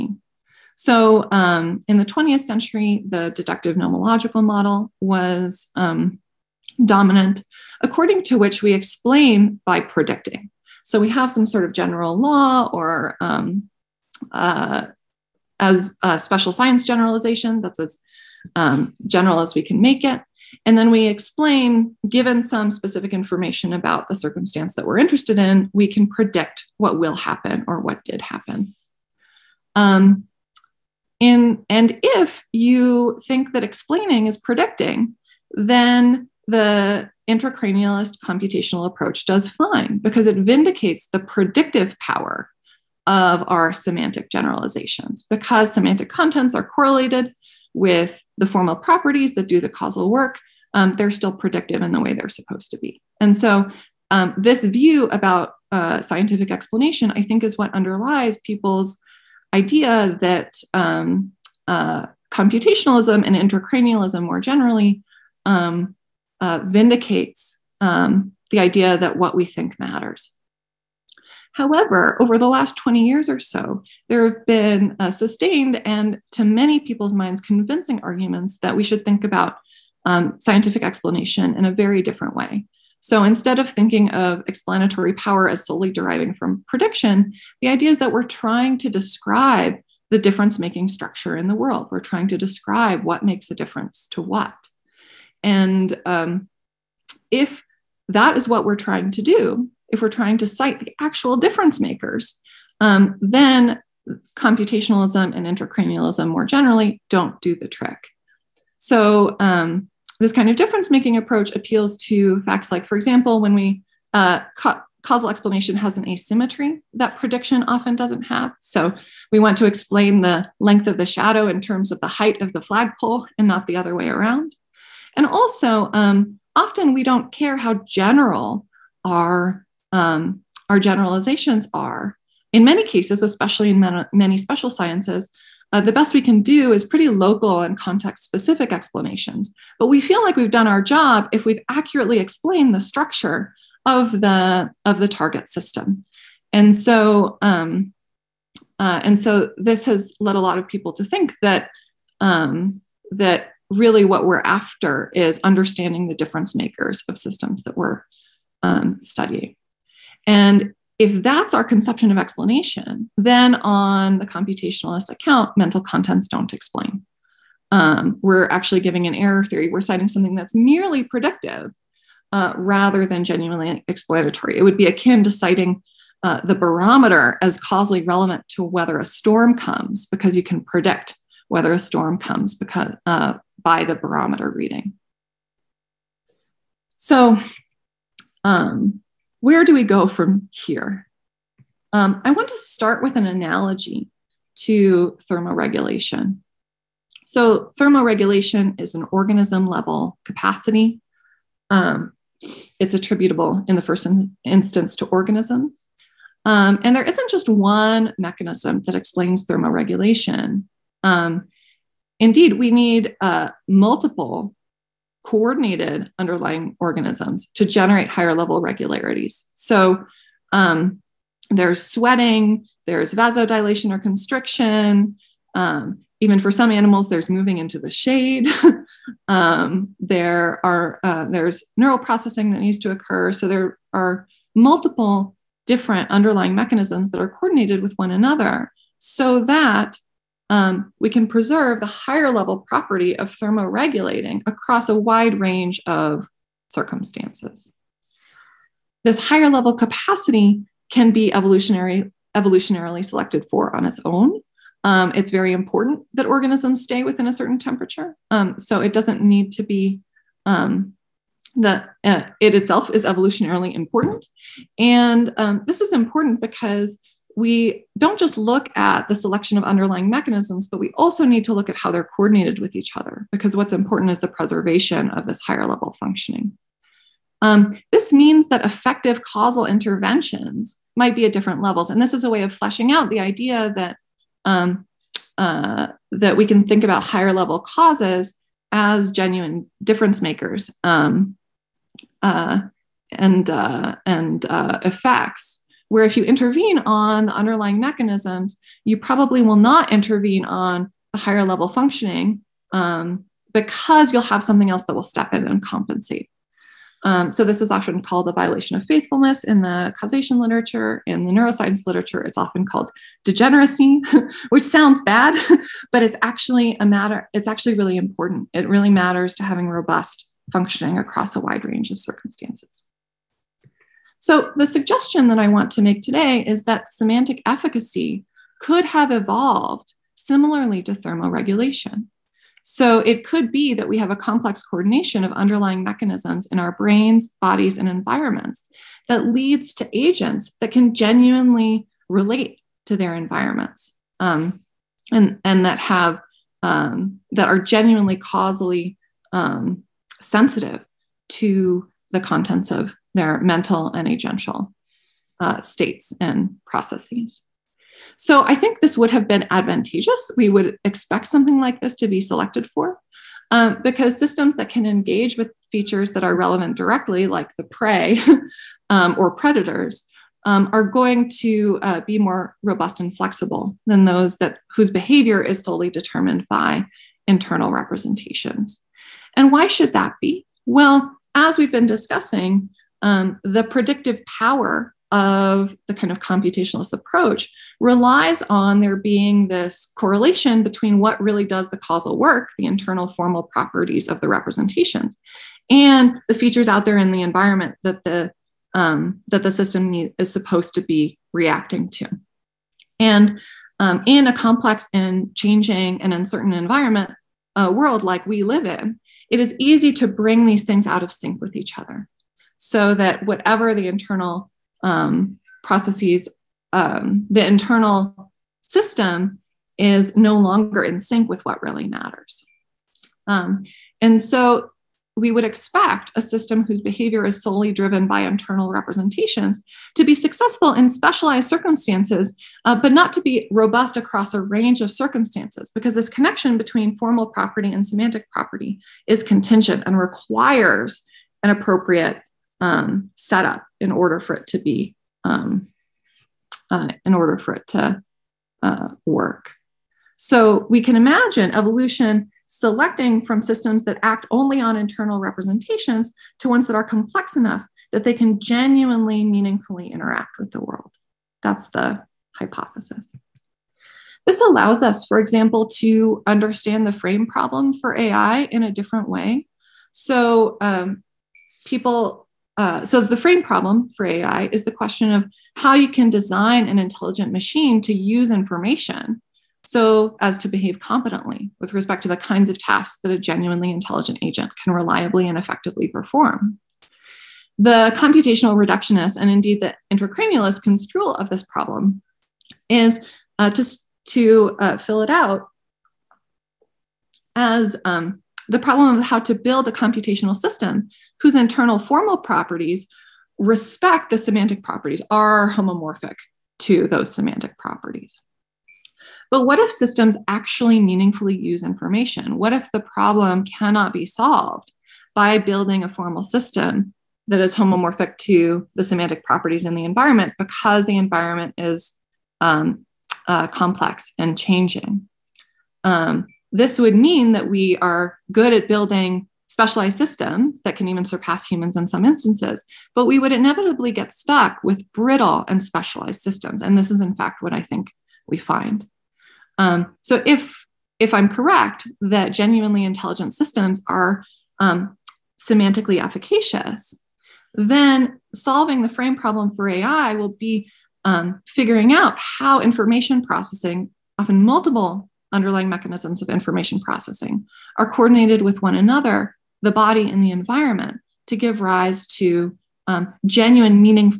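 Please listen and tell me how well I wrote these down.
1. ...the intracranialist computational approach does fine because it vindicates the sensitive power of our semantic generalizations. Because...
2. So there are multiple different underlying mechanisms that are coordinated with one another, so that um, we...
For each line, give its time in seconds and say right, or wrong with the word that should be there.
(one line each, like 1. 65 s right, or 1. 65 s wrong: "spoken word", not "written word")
1. 36 s wrong: "predictive", not "sensitive"
2. 233 s right.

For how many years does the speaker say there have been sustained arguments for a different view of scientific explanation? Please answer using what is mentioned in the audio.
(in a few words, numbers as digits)
20.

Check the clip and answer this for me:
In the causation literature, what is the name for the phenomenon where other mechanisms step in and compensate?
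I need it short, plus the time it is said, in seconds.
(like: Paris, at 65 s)
Violation of faithfulness, at 308 s.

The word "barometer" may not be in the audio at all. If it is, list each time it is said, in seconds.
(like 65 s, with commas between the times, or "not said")
176 s, 183 s.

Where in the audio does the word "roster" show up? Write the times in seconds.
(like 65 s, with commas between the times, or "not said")
not said.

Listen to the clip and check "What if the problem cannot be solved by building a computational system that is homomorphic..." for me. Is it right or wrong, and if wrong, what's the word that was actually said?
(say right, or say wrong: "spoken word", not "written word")
wrong: "formal", not "computational".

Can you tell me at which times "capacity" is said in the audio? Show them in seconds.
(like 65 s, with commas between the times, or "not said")
200 s, 249 s.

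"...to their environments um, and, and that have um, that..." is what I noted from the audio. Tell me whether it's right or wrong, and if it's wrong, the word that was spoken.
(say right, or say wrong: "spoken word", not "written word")
right.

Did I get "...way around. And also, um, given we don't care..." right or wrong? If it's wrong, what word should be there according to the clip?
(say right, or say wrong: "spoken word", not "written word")
wrong: "often", not "given".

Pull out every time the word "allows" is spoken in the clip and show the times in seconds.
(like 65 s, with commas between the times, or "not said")
464 s.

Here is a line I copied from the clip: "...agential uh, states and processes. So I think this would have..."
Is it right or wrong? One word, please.
right.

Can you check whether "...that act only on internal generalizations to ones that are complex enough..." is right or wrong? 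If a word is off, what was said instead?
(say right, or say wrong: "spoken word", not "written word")
wrong: "representations", not "generalizations".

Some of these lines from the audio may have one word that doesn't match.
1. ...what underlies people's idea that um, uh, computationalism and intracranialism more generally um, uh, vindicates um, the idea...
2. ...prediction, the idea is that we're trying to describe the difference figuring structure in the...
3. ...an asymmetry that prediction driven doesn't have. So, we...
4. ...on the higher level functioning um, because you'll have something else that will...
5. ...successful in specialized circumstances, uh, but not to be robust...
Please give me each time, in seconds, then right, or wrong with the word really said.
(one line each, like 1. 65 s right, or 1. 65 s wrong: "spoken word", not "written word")
1. 57 s right
2. 86 s wrong: "making", not "figuring"
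3. 115 s wrong: "often", not "driven"
4. 300 s right
5. 430 s right.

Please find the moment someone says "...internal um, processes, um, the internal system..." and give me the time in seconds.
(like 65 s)
413 s.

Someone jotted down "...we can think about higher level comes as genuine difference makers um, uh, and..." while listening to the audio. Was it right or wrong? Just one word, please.
wrong.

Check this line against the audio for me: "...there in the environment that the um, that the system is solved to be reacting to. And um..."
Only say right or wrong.
wrong.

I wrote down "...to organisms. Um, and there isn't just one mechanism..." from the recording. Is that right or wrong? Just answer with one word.
right.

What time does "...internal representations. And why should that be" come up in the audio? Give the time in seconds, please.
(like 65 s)
377 s.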